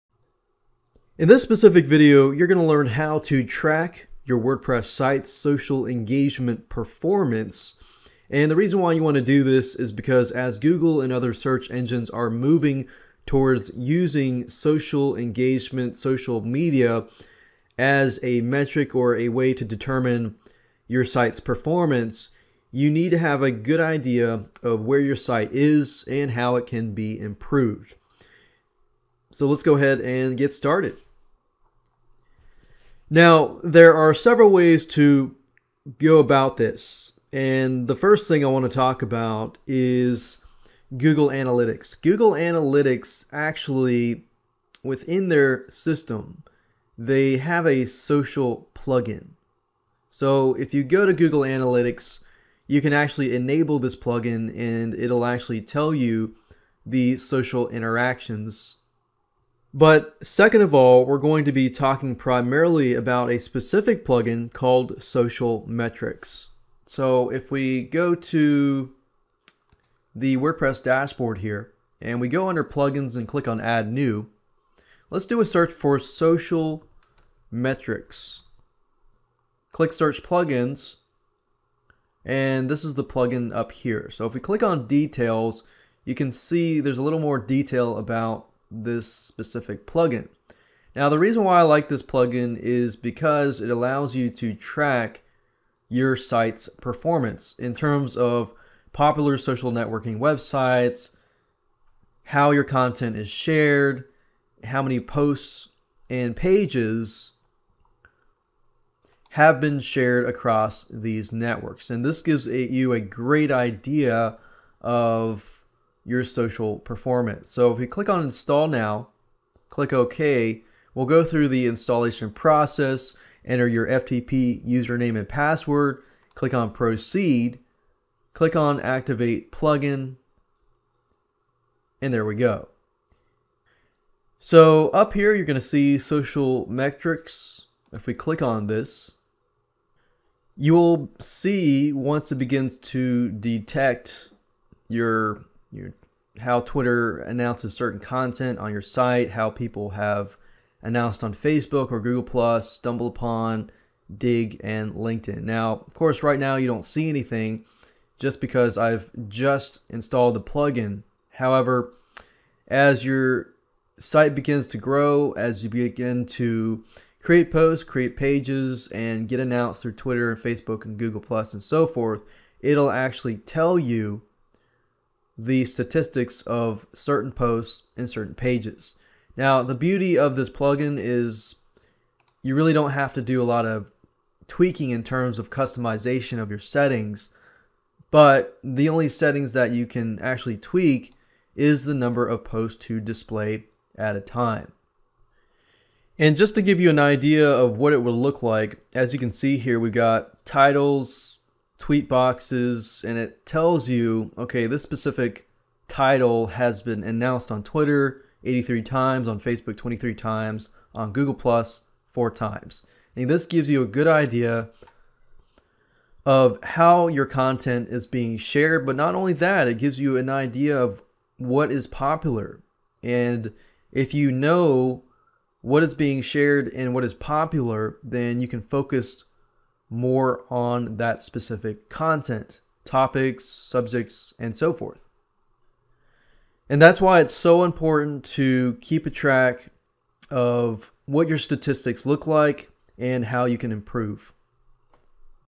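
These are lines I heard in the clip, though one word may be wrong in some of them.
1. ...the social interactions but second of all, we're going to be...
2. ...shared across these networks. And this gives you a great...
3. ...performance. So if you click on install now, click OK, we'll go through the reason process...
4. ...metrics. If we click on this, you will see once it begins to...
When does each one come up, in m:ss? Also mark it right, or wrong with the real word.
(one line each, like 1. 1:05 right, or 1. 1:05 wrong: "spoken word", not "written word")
1. 0:56 right
2. 1:49 right
3. 1:56 wrong: "installation", not "reason"
4. 2:16 right.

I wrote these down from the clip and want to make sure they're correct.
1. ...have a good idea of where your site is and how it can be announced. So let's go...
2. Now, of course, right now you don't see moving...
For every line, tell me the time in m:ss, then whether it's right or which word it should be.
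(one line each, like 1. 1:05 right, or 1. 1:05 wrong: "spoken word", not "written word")
1. 0:23 wrong: "improved", not "announced"
2. 2:35 wrong: "anything", not "moving".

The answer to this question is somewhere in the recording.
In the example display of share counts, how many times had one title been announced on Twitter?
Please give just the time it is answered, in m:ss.
3:28.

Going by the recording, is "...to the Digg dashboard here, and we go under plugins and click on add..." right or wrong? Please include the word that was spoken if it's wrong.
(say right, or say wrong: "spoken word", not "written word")
wrong: "WordPress", not "Digg".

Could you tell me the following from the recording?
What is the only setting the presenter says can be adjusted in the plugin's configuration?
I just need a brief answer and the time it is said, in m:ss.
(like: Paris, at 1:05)
number of posts to display, at 3:11.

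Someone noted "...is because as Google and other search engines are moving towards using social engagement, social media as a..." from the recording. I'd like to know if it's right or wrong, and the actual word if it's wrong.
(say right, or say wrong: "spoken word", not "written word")
right.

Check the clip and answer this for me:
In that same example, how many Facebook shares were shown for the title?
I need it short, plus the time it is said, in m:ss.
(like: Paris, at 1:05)
23, at 3:29.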